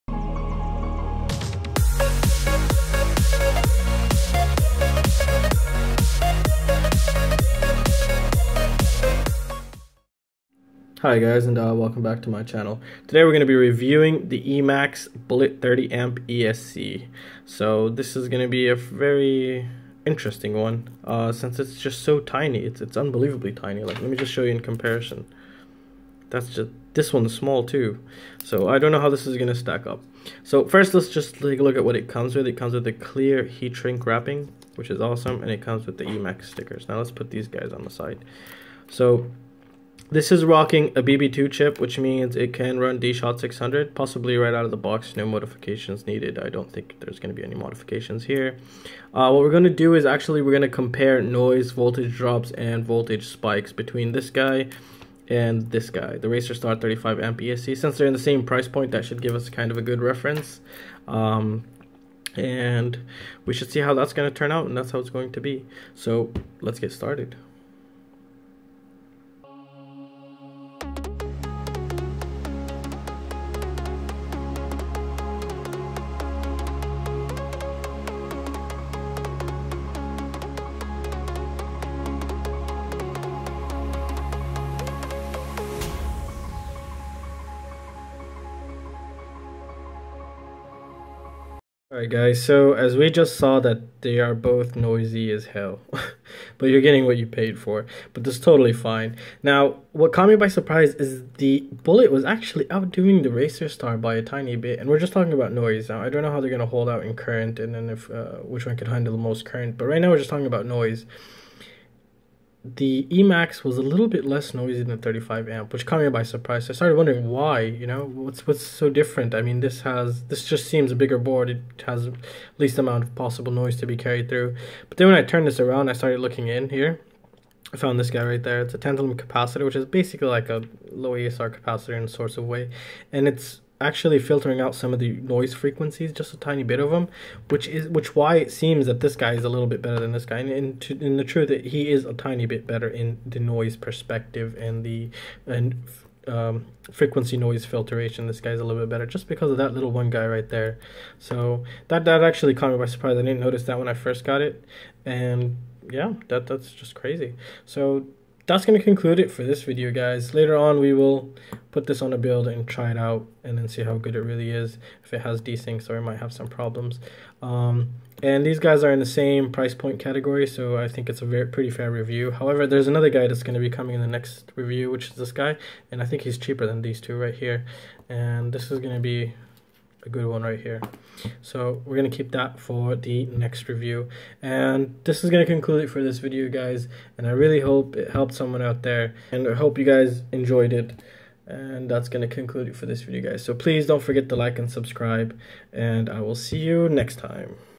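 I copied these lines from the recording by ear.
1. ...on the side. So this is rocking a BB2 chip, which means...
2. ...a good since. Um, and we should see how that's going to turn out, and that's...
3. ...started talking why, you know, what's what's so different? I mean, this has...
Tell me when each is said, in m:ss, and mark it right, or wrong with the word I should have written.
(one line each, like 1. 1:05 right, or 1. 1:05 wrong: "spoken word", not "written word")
1. 0:37 right
2. 0:59 wrong: "reference", not "since"
3. 1:56 wrong: "wondering", not "talking".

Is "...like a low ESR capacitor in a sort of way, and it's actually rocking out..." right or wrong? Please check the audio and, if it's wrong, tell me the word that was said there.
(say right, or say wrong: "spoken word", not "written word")
wrong: "filtering", not "rocking".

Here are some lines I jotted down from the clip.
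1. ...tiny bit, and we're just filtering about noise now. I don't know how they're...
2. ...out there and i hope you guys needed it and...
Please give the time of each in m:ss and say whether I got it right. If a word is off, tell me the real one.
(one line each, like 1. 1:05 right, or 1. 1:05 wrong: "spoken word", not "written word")
1. 1:44 wrong: "talking", not "filtering"
2. 3:08 wrong: "enjoyed", not "needed".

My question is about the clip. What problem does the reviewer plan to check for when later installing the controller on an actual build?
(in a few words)
desyncs.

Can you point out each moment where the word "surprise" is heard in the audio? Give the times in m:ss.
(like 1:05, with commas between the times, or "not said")
1:40, 1:56, 2:32.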